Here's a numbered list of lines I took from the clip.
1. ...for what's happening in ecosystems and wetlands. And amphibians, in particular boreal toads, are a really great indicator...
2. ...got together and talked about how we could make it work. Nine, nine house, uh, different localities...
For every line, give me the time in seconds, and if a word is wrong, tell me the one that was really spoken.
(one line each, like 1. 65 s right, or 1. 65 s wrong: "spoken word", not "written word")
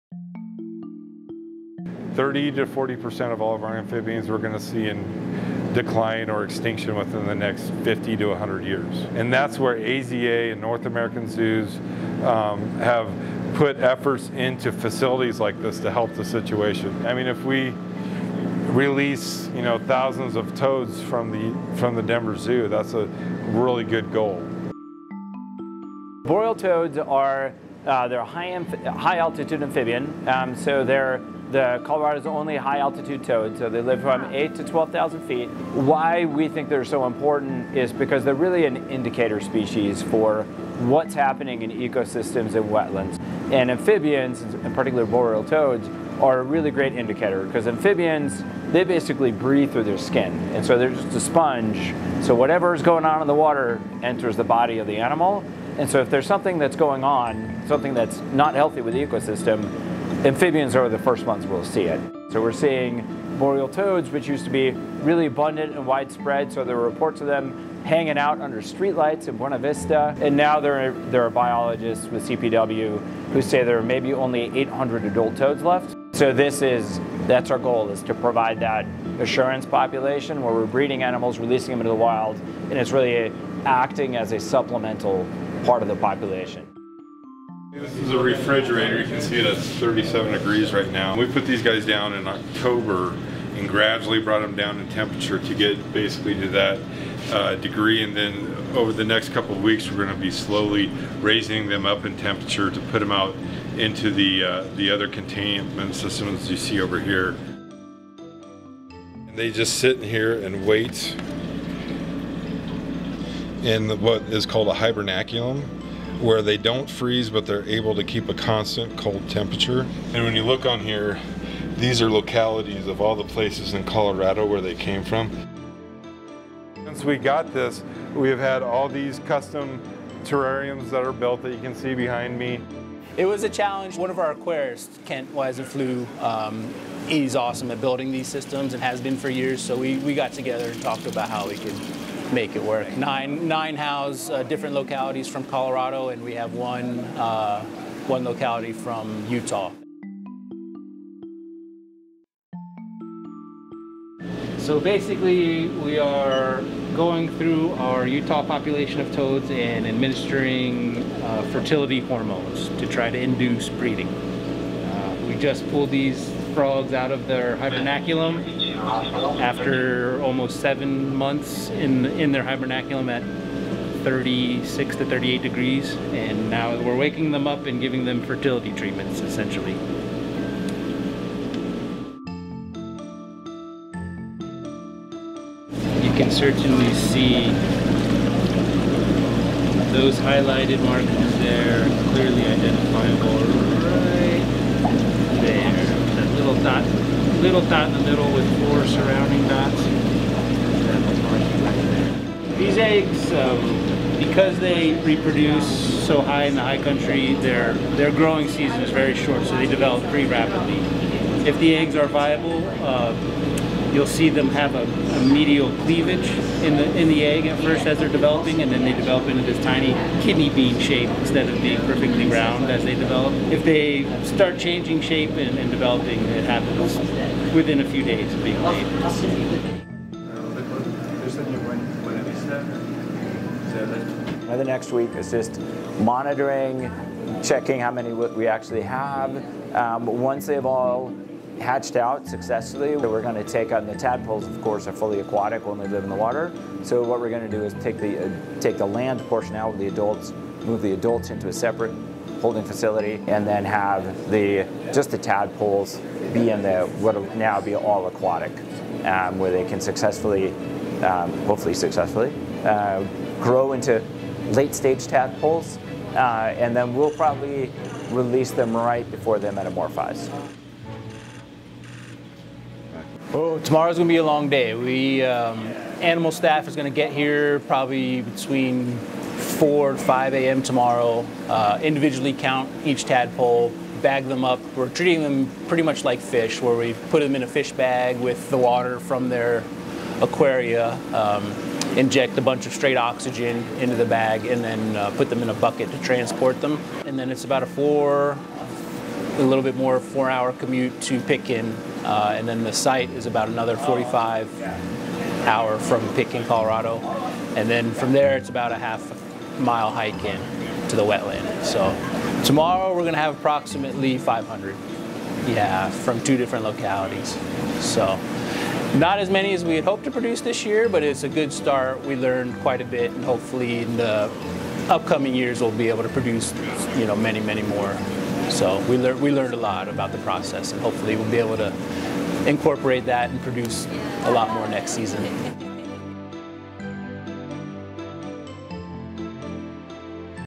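1. 40 s right
2. 140 s right.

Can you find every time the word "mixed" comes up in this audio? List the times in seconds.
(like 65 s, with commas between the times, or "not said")
not said.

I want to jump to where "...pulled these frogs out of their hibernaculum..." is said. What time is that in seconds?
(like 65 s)
165 s.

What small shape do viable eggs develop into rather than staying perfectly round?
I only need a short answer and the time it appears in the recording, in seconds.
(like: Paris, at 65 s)
kidney bean, at 220 s.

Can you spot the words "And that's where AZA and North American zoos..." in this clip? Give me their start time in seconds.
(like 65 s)
9 s.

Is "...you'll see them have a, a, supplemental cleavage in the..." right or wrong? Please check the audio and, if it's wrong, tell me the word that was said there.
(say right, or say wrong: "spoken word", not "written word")
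wrong: "medial", not "supplemental".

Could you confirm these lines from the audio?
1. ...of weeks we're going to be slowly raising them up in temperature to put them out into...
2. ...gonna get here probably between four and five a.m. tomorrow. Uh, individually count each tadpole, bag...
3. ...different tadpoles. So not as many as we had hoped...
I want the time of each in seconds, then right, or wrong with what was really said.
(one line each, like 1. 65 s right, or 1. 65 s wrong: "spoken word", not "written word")
1. 99 s right
2. 276 s right
3. 316 s wrong: "localities", not "tadpoles".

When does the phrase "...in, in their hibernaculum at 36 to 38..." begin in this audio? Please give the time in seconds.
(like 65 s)
171 s.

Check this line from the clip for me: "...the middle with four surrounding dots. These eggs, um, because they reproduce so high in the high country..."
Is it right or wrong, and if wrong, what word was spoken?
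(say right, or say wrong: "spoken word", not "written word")
right.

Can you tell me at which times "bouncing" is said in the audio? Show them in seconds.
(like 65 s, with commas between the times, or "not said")
not said.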